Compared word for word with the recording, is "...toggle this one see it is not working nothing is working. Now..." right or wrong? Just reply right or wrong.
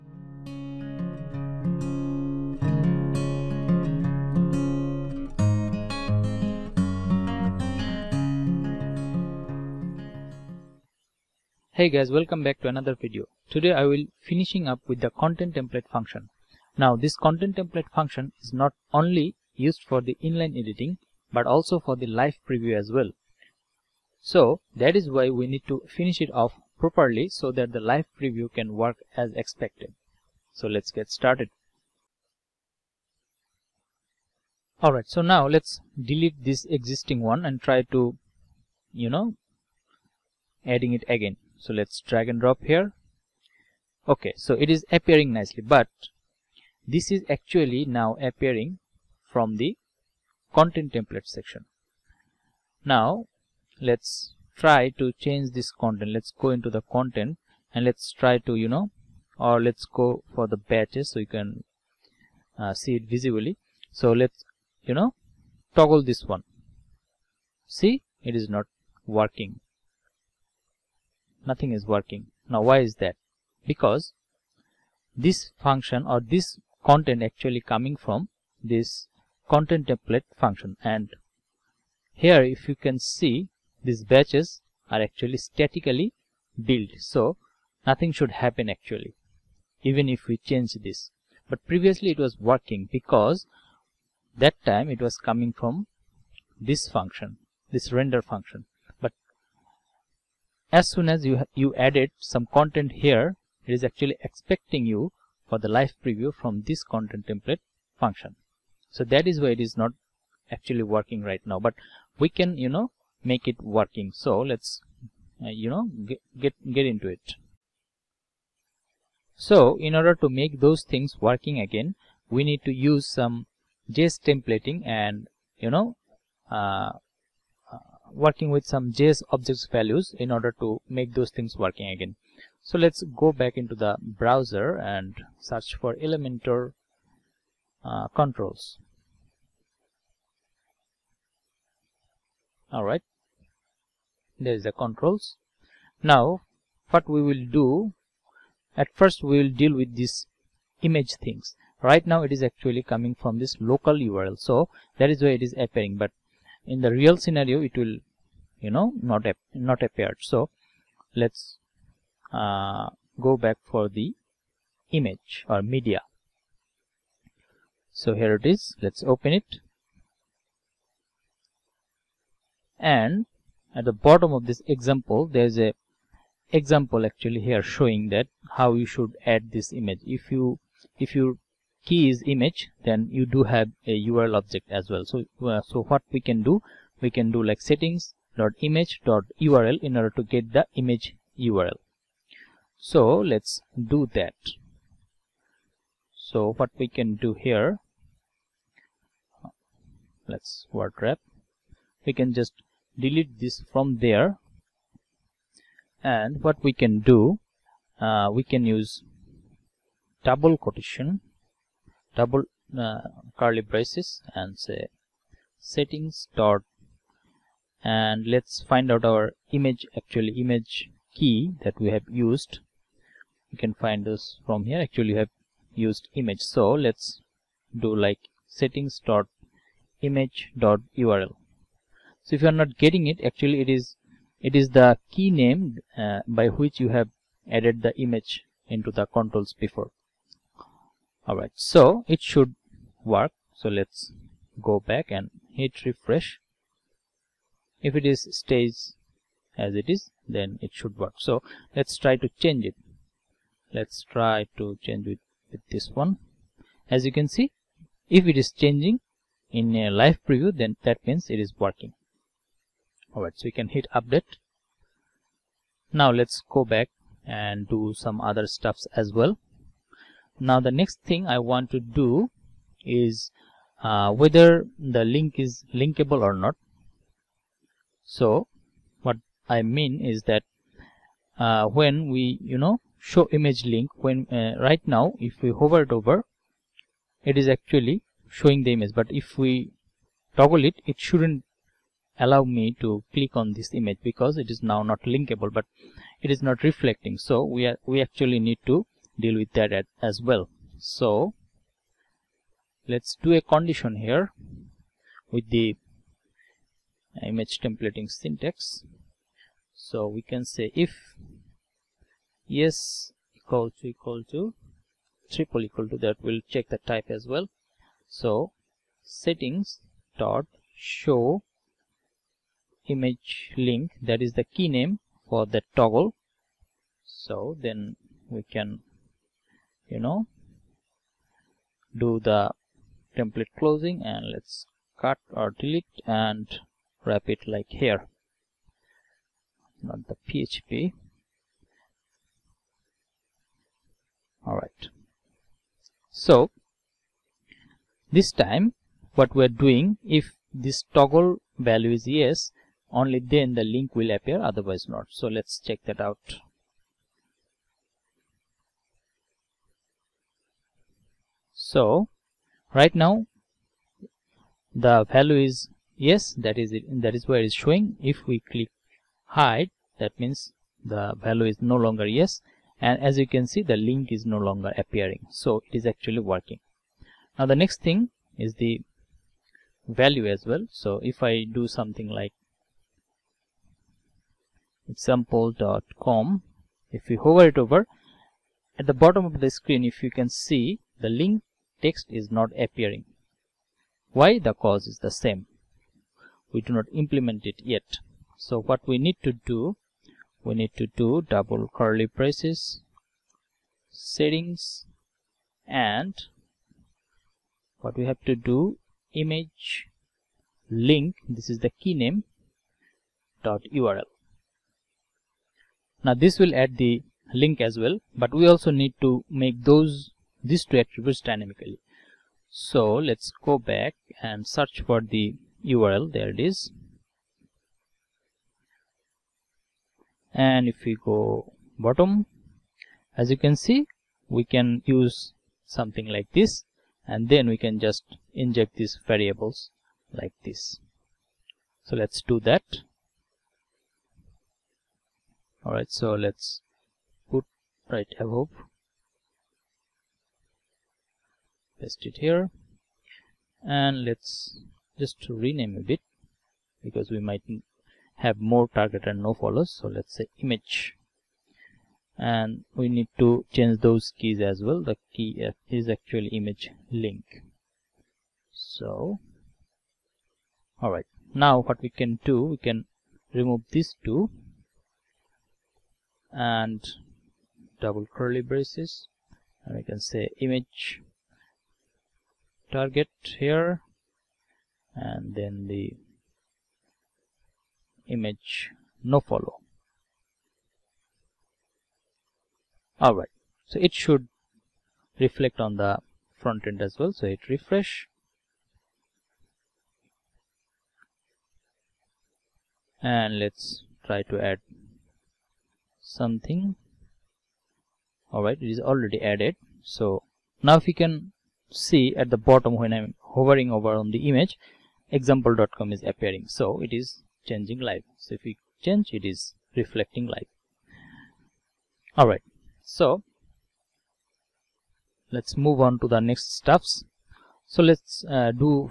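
right.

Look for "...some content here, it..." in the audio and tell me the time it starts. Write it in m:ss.
1:42.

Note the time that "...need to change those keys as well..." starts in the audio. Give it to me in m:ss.
7:42.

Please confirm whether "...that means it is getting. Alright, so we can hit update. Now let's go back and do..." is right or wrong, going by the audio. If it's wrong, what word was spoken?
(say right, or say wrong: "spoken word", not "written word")
wrong: "working", not "getting".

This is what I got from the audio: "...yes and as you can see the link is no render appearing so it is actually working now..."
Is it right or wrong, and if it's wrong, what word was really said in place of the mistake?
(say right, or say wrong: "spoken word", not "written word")
wrong: "longer", not "render".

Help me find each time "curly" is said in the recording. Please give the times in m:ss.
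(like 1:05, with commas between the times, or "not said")
3:33, 6:41, 7:58.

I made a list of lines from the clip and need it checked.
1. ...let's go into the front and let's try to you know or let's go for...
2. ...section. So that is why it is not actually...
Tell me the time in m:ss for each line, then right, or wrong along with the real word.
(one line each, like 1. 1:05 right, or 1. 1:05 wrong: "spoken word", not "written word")
1. 0:56 wrong: "content", not "front"
2. 1:47 wrong: "function", not "section".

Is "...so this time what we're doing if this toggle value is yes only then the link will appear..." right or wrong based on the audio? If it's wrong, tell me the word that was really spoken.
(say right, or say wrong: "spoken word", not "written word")
right.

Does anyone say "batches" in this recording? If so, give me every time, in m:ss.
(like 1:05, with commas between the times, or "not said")
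1:00, 1:24.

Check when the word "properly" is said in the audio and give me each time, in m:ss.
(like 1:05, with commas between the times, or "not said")
0:26.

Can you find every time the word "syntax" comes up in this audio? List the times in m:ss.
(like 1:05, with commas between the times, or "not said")
5:08.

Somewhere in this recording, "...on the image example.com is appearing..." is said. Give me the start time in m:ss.
8:33.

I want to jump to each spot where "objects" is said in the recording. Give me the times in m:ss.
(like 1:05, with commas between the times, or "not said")
2:09, 3:04.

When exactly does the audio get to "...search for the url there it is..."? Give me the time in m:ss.
7:04.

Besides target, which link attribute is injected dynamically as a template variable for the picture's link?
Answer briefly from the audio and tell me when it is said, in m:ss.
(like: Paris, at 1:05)
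no follow, at 8:09.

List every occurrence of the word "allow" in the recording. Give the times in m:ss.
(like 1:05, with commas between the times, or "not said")
4:52.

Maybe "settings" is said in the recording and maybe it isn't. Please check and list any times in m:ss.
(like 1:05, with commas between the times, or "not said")
3:07, 3:35, 3:48, 5:19, 6:43.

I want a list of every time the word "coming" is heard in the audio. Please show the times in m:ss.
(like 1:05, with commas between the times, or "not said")
1:17, 1:35, 2:32.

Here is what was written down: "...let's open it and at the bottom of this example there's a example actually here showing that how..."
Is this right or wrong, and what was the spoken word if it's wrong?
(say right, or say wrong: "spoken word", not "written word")
right.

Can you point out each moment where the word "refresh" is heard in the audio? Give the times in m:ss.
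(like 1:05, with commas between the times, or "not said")
4:05, 8:17.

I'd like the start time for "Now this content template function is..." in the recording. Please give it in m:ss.
0:16.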